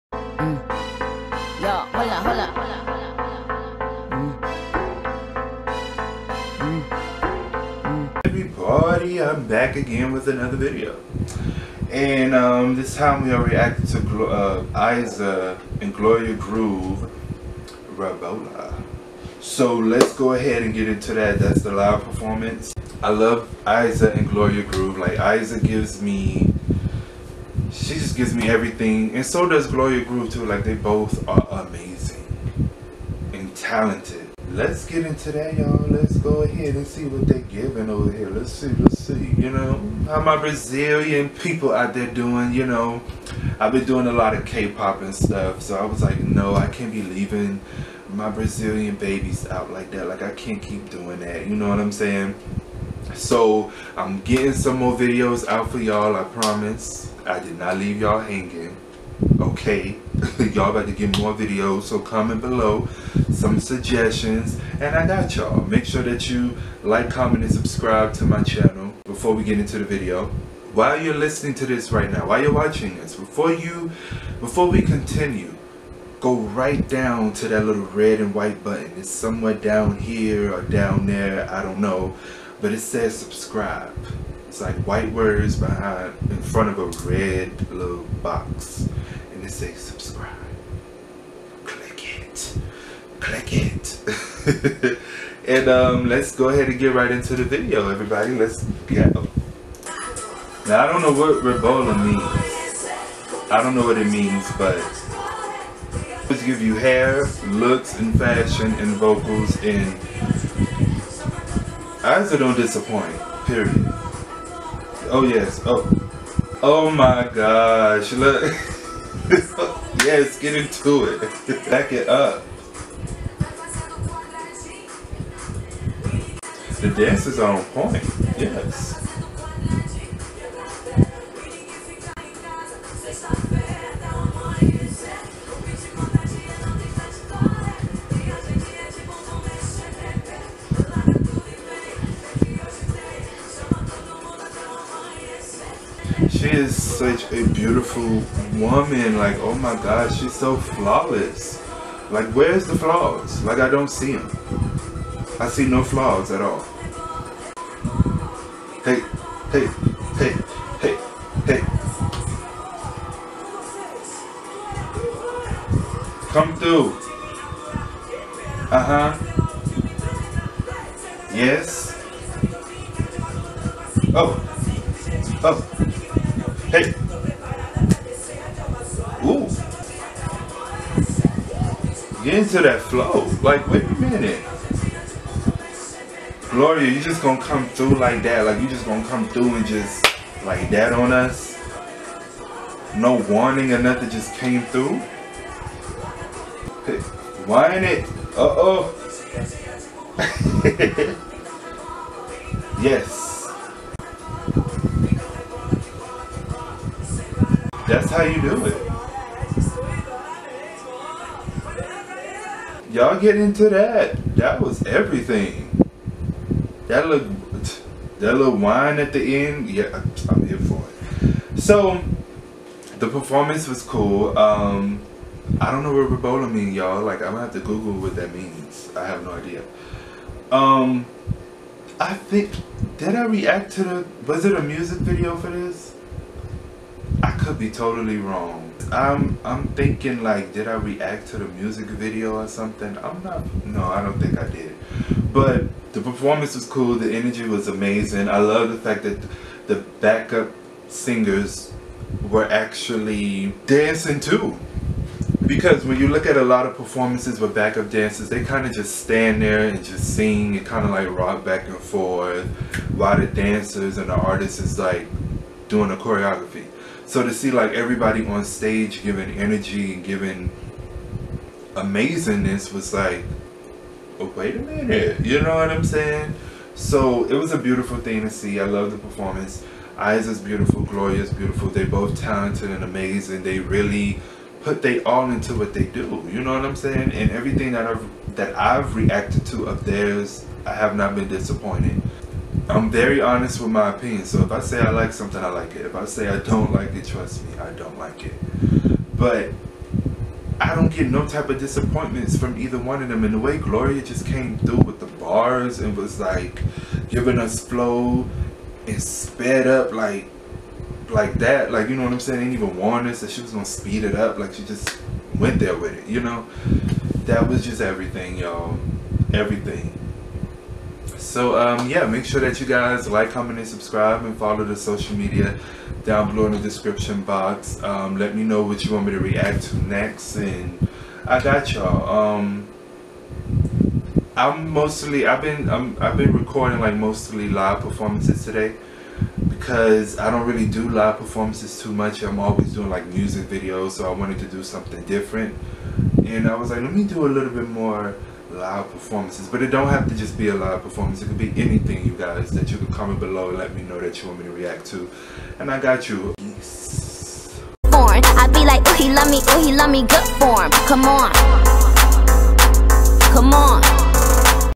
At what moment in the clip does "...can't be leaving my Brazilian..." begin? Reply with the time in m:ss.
0:46.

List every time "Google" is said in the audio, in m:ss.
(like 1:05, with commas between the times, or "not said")
3:47.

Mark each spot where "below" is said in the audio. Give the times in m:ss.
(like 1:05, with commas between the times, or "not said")
1:02, 5:26, 5:53.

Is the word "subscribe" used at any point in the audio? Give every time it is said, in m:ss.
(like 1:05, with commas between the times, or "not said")
1:07, 1:23, 1:29, 5:23.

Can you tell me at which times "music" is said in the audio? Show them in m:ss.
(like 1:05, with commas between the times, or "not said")
3:54, 4:01, 5:43.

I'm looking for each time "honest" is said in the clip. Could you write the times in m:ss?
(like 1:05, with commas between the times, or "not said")
4:53.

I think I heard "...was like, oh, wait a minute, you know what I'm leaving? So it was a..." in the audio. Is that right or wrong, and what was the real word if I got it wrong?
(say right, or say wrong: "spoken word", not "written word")
wrong: "saying", not "leaving".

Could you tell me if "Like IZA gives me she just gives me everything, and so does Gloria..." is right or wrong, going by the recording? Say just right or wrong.
right.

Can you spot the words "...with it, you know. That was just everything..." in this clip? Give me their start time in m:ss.
5:15.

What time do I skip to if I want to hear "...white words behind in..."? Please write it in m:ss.
1:24.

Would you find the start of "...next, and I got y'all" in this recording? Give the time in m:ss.
5:29.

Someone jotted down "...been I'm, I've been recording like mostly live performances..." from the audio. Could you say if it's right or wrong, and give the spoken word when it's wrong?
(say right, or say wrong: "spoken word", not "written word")
right.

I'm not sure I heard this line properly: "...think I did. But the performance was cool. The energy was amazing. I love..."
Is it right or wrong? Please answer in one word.
right.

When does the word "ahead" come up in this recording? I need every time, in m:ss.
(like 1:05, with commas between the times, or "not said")
0:20, 0:36, 1:36.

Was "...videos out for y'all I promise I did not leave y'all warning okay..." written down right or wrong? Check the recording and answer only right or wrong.
wrong.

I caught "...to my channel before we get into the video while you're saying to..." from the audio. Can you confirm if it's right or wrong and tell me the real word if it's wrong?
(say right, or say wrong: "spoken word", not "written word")
wrong: "listening", not "saying".